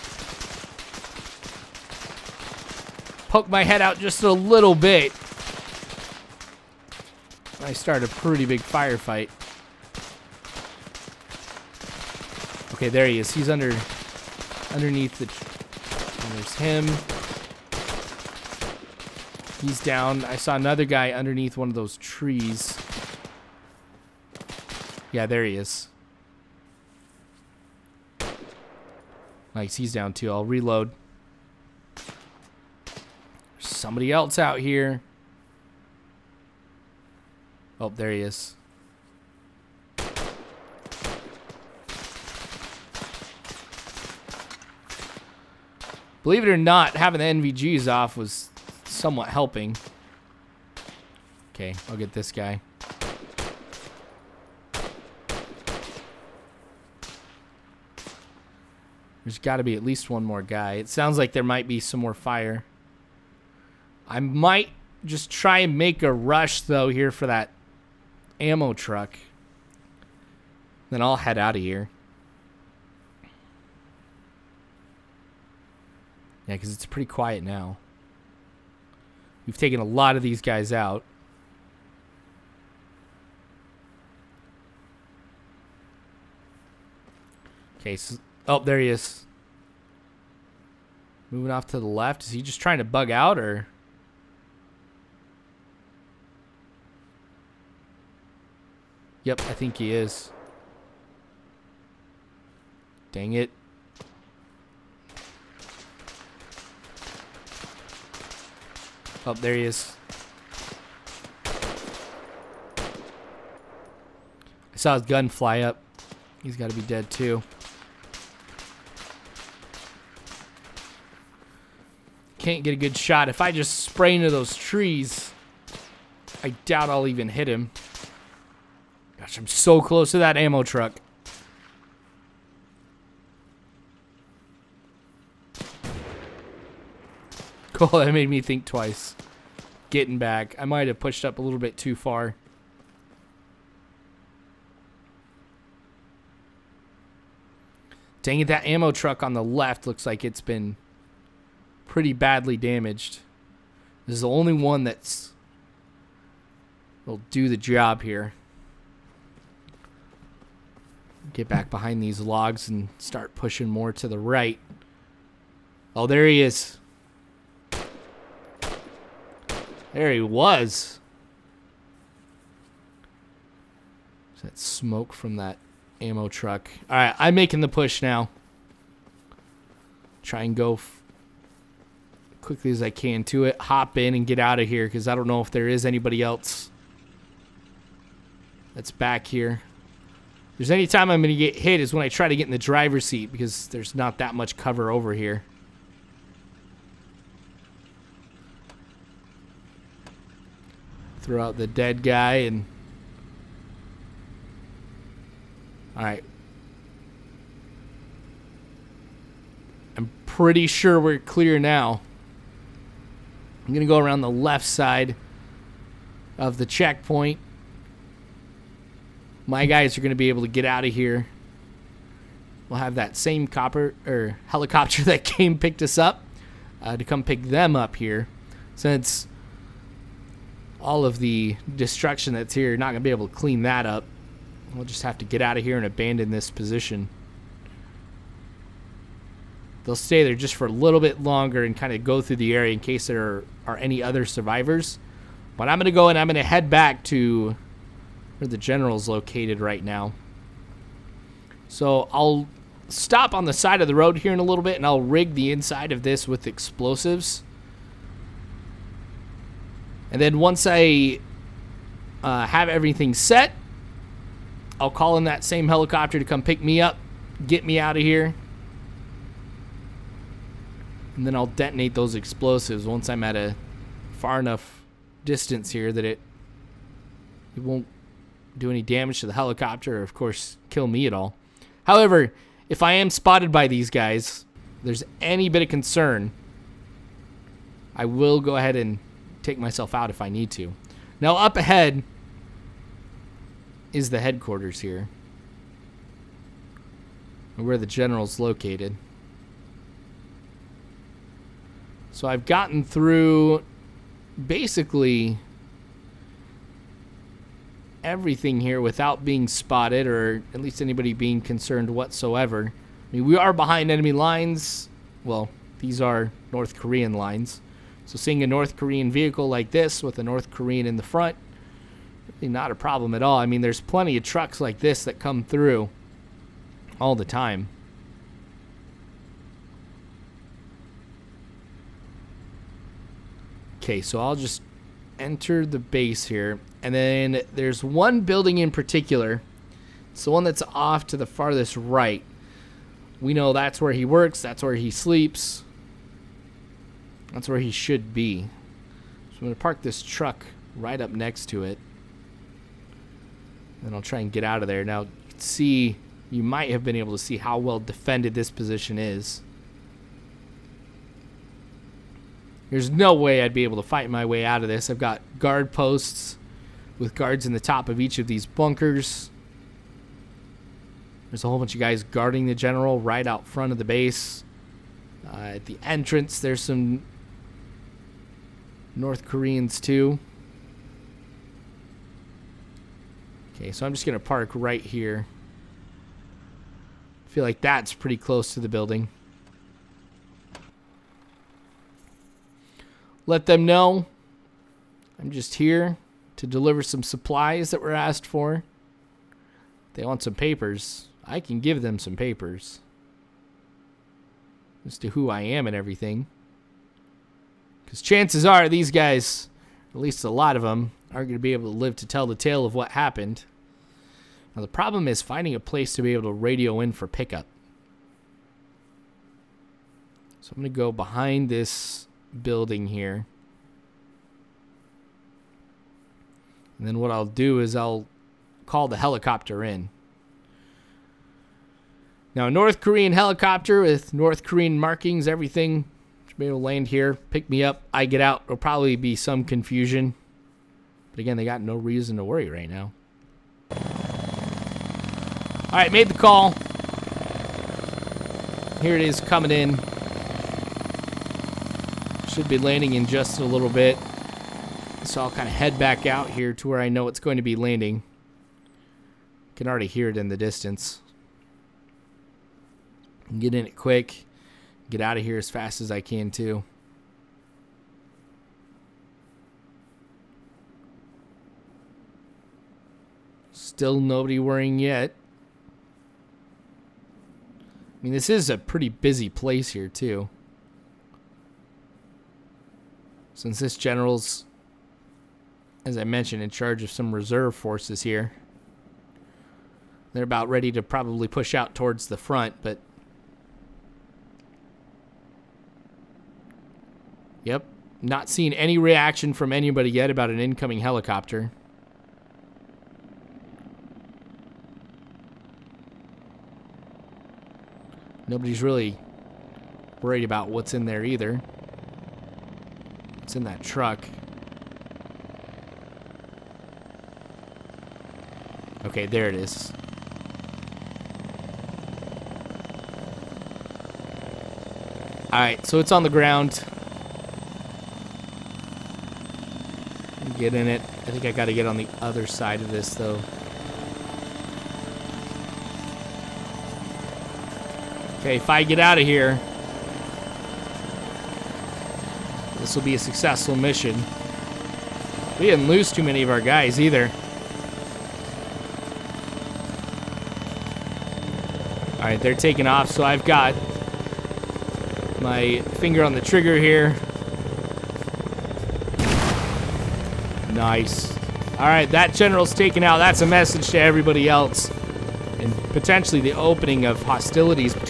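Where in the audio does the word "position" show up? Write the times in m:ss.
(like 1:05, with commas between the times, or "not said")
3:56, 5:58.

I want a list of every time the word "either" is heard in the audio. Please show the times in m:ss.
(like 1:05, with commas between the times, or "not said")
8:31, 9:06.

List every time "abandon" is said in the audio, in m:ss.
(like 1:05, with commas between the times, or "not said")
3:55.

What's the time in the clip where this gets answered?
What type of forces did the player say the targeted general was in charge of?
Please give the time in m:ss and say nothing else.
8:07.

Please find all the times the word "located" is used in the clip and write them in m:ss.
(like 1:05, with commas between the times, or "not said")
4:09, 4:58.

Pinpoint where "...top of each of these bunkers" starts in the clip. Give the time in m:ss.
6:07.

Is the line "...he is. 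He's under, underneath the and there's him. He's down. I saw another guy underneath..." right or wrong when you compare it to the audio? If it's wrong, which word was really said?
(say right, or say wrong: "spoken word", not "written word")
right.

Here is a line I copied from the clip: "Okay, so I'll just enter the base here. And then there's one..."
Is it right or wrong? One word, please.
right.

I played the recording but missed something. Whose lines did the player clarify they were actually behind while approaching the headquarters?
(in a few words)
North Korean lines.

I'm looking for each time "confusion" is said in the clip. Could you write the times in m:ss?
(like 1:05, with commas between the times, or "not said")
7:19.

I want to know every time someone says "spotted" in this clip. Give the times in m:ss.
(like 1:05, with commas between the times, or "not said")
4:43, 5:09.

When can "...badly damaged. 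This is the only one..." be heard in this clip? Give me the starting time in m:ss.
2:32.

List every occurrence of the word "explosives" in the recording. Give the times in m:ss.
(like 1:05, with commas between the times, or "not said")
4:16, 4:32.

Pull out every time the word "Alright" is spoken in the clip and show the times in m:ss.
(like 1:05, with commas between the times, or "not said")
8:45.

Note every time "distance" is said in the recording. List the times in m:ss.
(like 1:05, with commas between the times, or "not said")
4:35, 7:40.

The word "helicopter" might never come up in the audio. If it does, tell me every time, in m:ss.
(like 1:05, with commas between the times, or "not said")
3:44, 4:25, 4:39, 7:08, 7:13, 8:20.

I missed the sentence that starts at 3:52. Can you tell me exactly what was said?
Not going to be able to clean that up.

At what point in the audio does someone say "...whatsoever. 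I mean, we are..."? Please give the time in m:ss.
5:11.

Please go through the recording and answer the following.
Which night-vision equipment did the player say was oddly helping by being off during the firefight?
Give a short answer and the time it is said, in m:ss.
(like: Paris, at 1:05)
NVGs, at 0:47.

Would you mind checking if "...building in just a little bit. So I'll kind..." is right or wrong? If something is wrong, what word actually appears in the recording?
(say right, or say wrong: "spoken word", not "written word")
wrong: "landing", not "building".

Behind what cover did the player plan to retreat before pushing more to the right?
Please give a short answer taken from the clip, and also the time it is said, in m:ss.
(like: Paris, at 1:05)
Logs, at 2:42.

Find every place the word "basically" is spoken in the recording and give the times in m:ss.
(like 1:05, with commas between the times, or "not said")
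5:04.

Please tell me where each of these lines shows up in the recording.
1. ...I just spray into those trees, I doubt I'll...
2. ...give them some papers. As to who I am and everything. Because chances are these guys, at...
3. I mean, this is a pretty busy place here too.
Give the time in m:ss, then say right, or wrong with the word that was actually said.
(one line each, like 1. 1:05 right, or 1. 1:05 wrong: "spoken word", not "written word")
1. 2:03 right
2. 6:41 right
3. 7:57 right.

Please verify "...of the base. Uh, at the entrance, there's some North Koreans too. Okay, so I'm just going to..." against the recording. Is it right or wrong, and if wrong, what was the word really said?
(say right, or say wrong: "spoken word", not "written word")
right.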